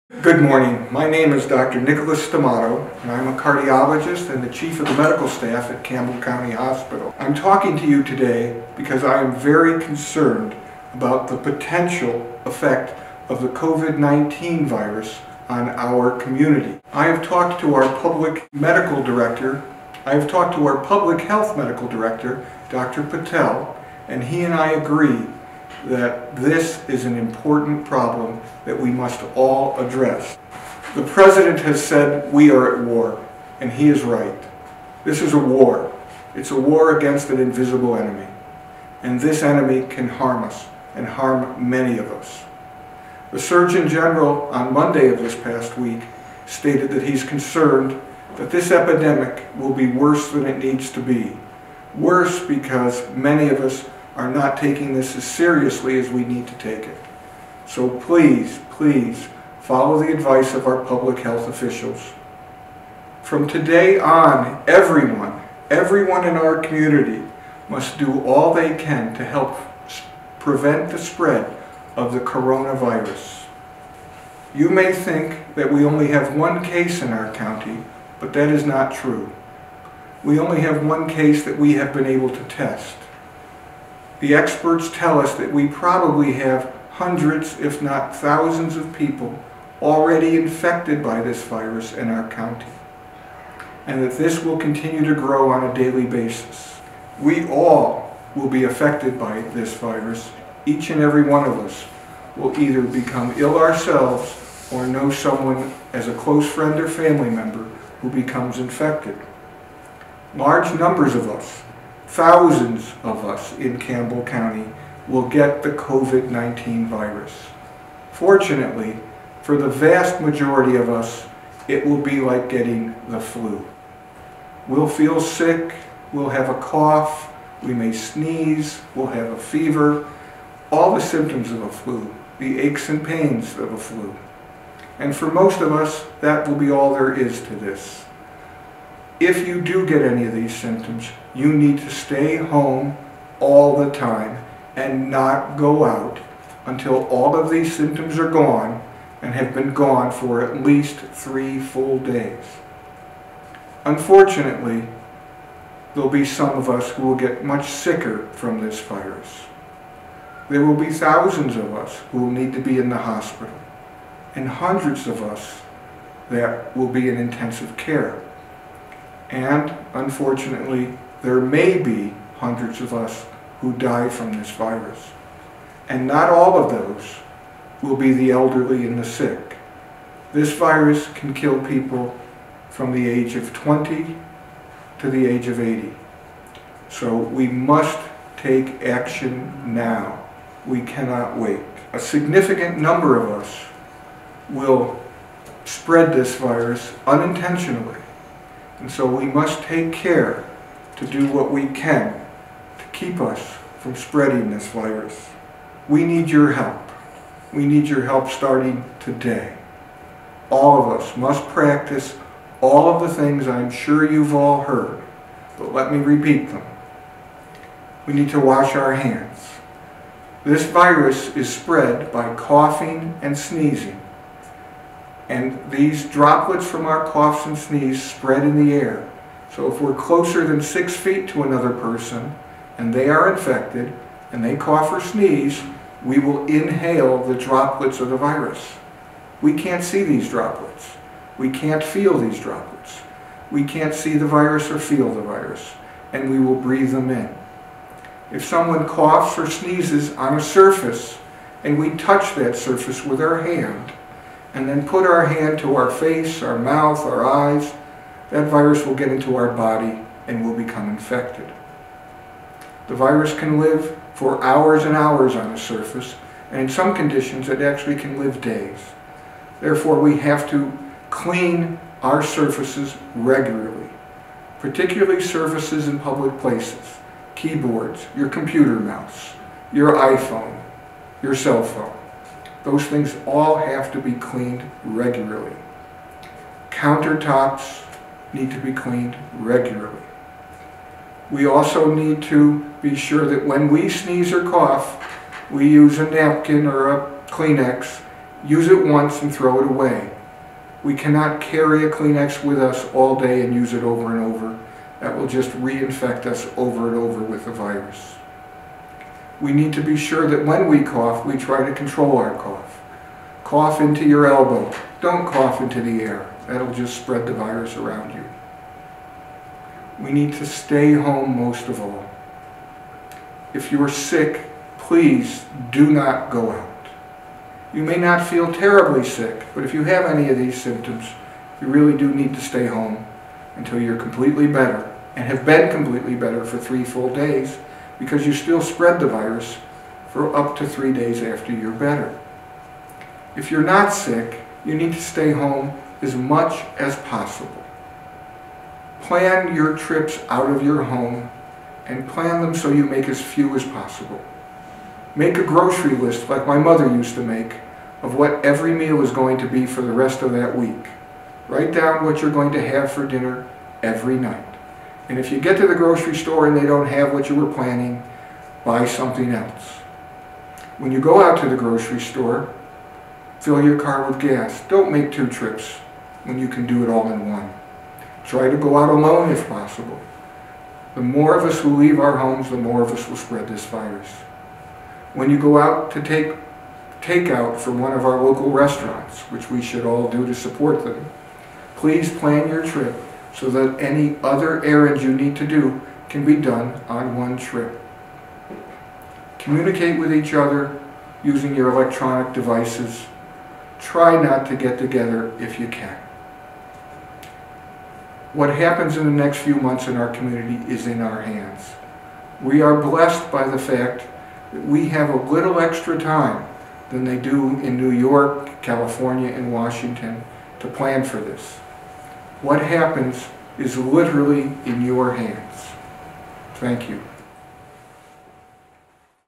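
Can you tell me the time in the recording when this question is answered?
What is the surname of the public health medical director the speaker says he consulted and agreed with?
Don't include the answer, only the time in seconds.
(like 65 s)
23 s.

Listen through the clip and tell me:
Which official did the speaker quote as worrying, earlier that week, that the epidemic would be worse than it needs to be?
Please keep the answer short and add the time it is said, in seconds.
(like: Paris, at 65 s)
The Surgeon General, at 43 s.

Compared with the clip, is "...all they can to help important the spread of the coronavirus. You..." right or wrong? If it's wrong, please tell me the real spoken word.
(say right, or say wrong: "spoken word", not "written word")
wrong: "prevent", not "important".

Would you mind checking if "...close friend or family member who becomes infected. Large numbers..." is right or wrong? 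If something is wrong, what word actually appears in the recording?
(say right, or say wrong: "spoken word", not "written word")
right.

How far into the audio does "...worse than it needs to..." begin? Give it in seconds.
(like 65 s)
49 s.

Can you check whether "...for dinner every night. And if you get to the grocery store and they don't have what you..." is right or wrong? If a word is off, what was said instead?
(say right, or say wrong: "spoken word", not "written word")
right.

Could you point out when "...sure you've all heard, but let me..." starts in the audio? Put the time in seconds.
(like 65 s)
213 s.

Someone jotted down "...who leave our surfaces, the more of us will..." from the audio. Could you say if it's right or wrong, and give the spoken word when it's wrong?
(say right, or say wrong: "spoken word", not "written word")
wrong: "homes", not "surfaces".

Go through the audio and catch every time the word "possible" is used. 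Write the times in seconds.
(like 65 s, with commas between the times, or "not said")
347 s, 353 s, 379 s.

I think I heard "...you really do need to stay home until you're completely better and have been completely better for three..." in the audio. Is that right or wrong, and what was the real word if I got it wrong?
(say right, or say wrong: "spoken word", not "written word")
right.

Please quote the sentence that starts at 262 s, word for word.
The virus can live for hours and hours on a surface, and in some conditions it actually can live days.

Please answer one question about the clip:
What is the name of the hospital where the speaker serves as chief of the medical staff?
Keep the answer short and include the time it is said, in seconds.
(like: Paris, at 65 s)
Campbell County Hospital, at 5 s.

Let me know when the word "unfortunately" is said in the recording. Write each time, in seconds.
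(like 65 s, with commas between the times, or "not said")
153 s, 169 s.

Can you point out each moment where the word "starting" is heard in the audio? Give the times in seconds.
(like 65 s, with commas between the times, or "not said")
208 s.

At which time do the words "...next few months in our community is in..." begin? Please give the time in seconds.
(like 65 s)
409 s.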